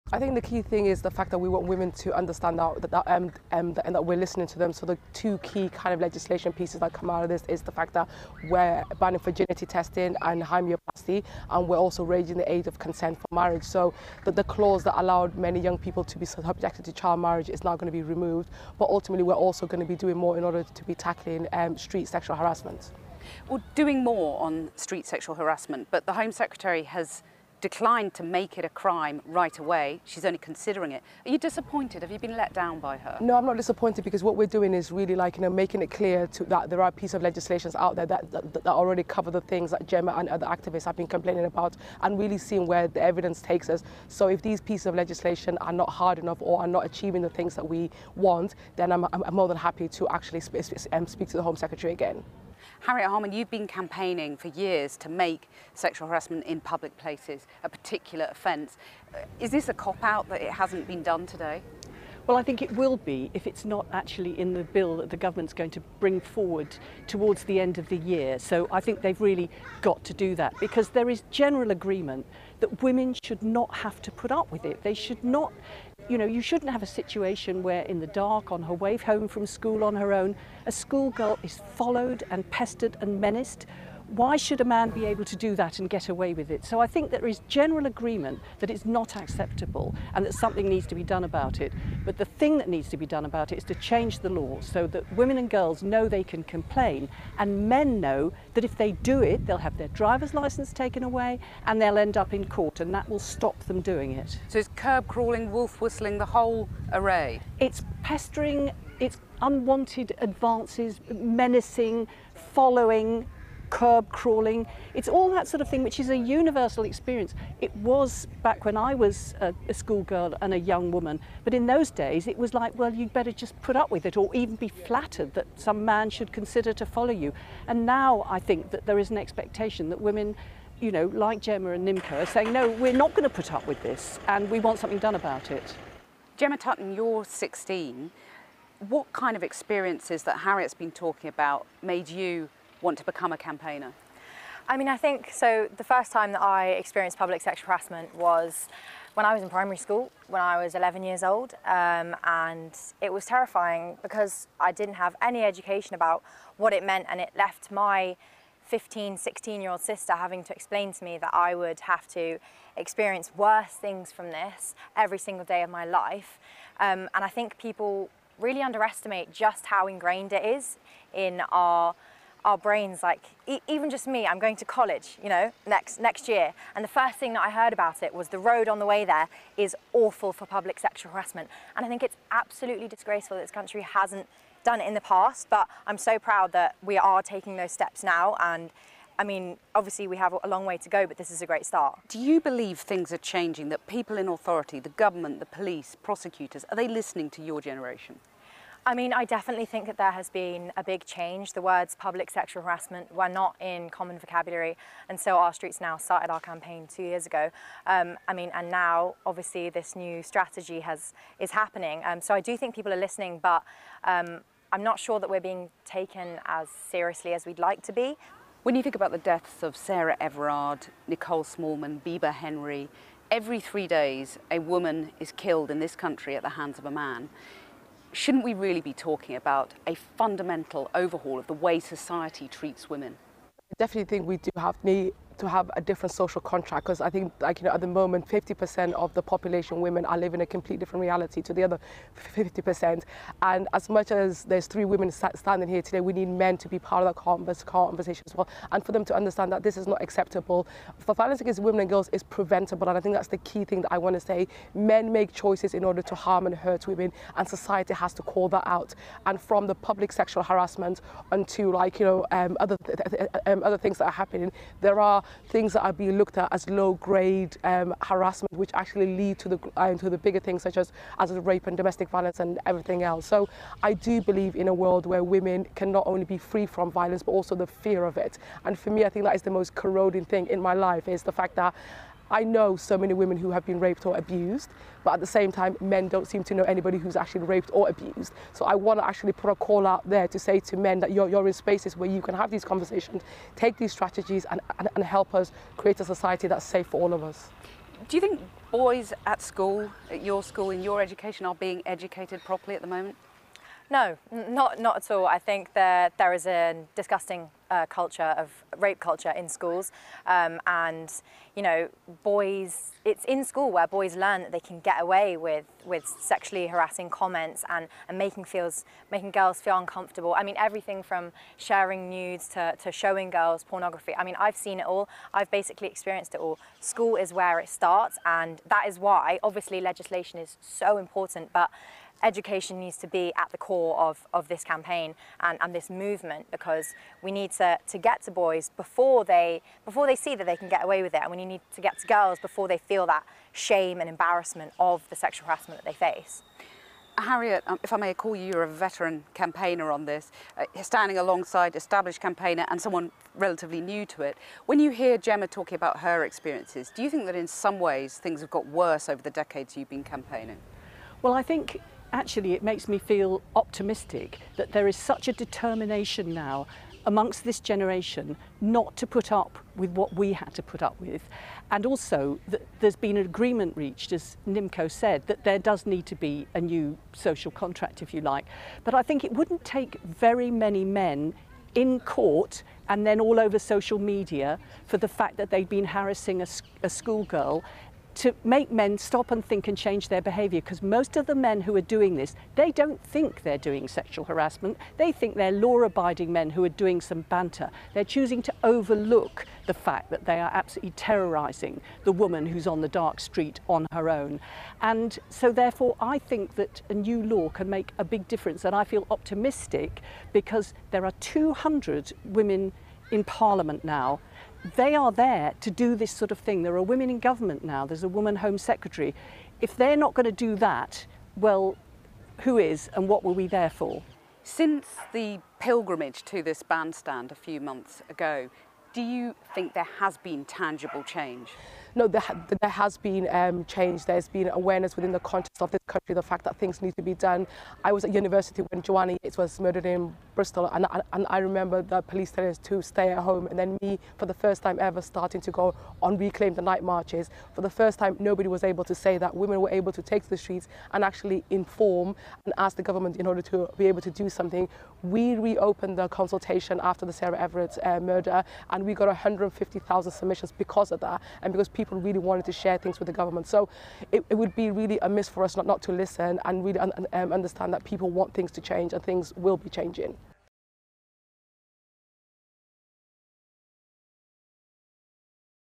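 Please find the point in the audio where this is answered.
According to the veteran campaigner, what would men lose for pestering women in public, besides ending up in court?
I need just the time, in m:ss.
1:39.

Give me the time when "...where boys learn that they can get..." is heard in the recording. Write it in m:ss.
5:13.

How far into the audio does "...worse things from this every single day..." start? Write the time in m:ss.
2:43.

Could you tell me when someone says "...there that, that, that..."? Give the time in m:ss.
0:37.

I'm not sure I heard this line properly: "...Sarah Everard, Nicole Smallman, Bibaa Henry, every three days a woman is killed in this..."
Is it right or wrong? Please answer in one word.
right.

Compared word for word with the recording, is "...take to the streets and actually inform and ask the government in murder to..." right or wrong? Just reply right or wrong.
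wrong.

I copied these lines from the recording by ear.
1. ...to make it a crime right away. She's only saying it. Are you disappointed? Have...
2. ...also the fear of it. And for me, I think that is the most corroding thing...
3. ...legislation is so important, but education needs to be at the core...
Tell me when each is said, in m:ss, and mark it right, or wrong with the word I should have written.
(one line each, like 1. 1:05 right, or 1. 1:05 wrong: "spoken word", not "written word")
1. 0:28 wrong: "considering", not "saying"
2. 4:37 right
3. 5:29 right.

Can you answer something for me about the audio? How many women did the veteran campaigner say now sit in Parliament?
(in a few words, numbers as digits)
200.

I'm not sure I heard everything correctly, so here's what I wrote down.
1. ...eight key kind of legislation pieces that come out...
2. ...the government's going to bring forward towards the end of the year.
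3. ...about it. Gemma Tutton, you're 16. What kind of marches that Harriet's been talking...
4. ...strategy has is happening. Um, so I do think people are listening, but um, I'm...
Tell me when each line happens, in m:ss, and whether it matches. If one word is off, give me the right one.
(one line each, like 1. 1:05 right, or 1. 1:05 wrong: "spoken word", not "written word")
1. 0:05 wrong: "two", not "eight"
2. 1:05 right
3. 2:15 wrong: "experiences", not "marches"
4. 3:30 right.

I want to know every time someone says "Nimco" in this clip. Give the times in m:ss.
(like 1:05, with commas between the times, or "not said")
2:11, 6:14.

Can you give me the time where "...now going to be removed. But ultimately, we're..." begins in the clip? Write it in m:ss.
0:17.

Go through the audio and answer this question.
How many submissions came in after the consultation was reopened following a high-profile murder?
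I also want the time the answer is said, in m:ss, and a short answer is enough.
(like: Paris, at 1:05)
150,000, at 7:39.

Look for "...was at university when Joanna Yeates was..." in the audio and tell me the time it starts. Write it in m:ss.
7:17.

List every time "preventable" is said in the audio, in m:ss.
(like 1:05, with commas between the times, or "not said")
4:12.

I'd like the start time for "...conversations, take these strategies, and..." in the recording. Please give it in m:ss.
4:52.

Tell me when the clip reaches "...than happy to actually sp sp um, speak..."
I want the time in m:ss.
0:49.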